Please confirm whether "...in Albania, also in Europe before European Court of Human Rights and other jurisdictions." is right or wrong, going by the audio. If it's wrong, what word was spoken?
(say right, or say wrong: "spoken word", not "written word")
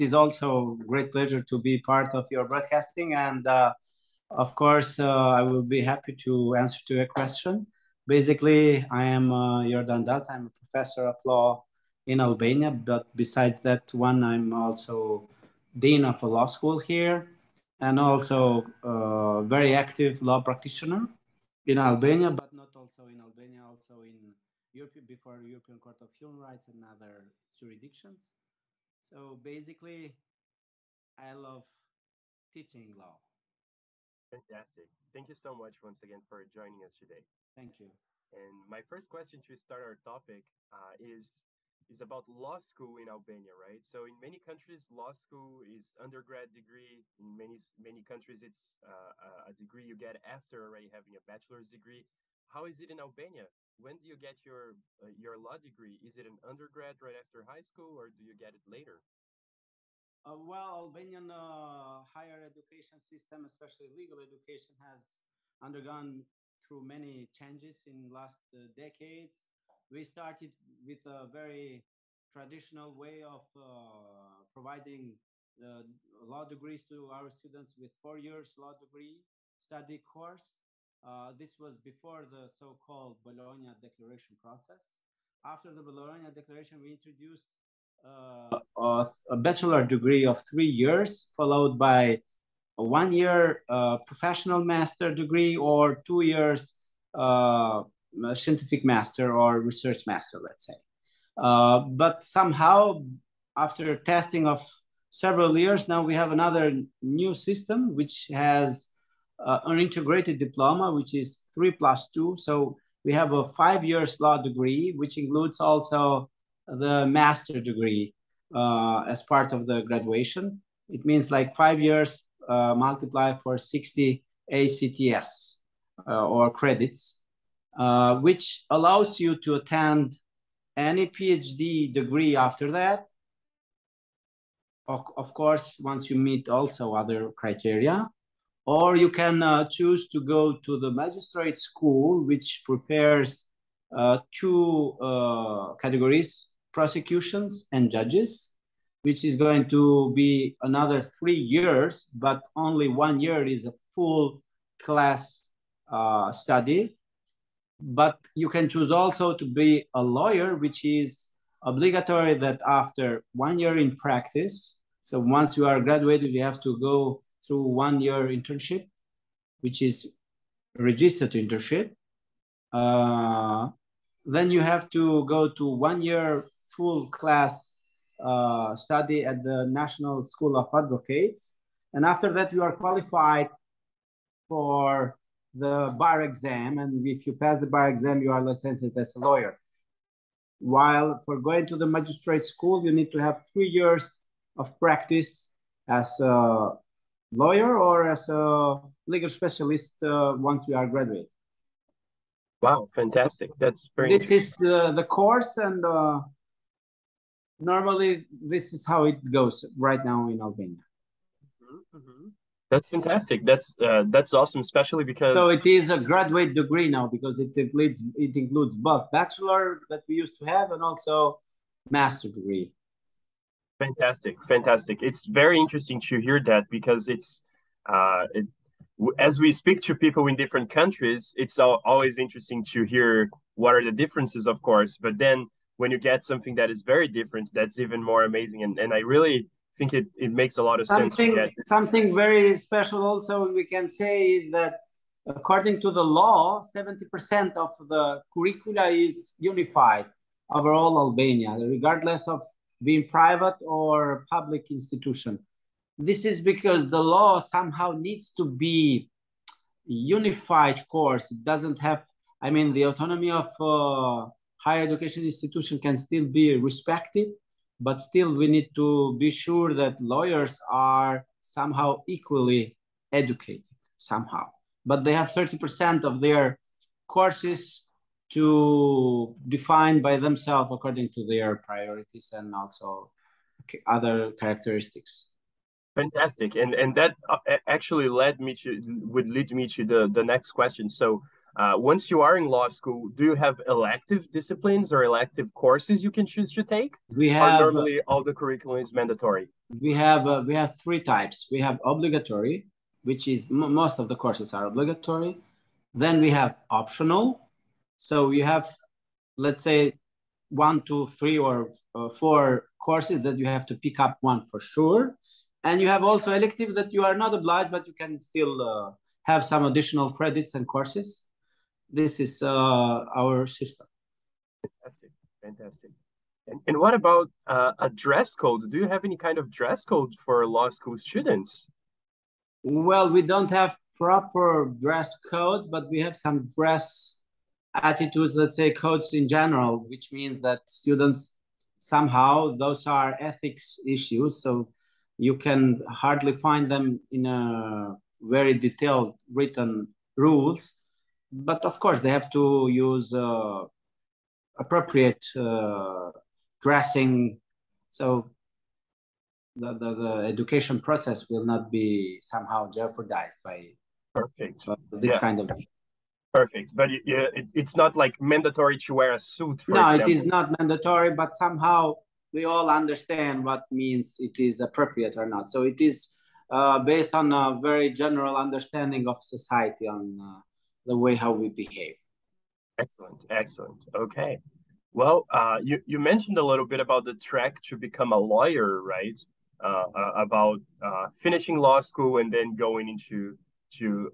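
right.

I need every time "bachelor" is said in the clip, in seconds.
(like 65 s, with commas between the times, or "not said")
51 s, 89 s, 219 s.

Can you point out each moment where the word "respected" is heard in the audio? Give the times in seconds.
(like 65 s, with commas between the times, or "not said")
266 s.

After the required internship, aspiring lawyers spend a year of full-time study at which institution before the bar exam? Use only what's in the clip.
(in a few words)
National School of Advocates.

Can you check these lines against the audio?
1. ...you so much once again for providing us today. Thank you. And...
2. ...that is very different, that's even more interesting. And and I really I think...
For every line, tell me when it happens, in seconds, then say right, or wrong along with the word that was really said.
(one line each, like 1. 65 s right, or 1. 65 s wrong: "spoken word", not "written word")
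1. 35 s wrong: "joining", not "providing"
2. 236 s wrong: "amazing", not "interesting".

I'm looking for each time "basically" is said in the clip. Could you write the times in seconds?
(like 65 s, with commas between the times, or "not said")
8 s, 29 s.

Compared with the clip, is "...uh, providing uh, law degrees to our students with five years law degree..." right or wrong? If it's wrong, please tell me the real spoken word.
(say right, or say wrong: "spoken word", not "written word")
wrong: "four", not "five".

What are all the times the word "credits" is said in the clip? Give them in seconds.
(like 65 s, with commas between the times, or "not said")
126 s, 320 s.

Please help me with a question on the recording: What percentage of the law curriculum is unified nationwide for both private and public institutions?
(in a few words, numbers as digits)
70%.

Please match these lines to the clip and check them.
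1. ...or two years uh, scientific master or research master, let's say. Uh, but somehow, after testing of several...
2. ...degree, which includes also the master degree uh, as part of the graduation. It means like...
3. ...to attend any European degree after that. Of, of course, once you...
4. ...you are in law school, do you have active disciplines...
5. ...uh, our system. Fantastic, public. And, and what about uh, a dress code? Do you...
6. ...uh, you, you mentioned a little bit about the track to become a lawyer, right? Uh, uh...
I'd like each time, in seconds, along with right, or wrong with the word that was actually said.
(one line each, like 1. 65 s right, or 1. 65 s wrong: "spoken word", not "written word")
1. 95 s right
2. 114 s right
3. 129 s wrong: "PhD", not "European"
4. 292 s wrong: "elective", not "active"
5. 322 s wrong: "fantastic", not "public"
6. 385 s right.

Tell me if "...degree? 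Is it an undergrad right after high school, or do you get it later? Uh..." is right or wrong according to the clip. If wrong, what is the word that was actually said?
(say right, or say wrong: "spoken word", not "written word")
right.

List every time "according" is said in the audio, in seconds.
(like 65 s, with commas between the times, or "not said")
245 s, 280 s.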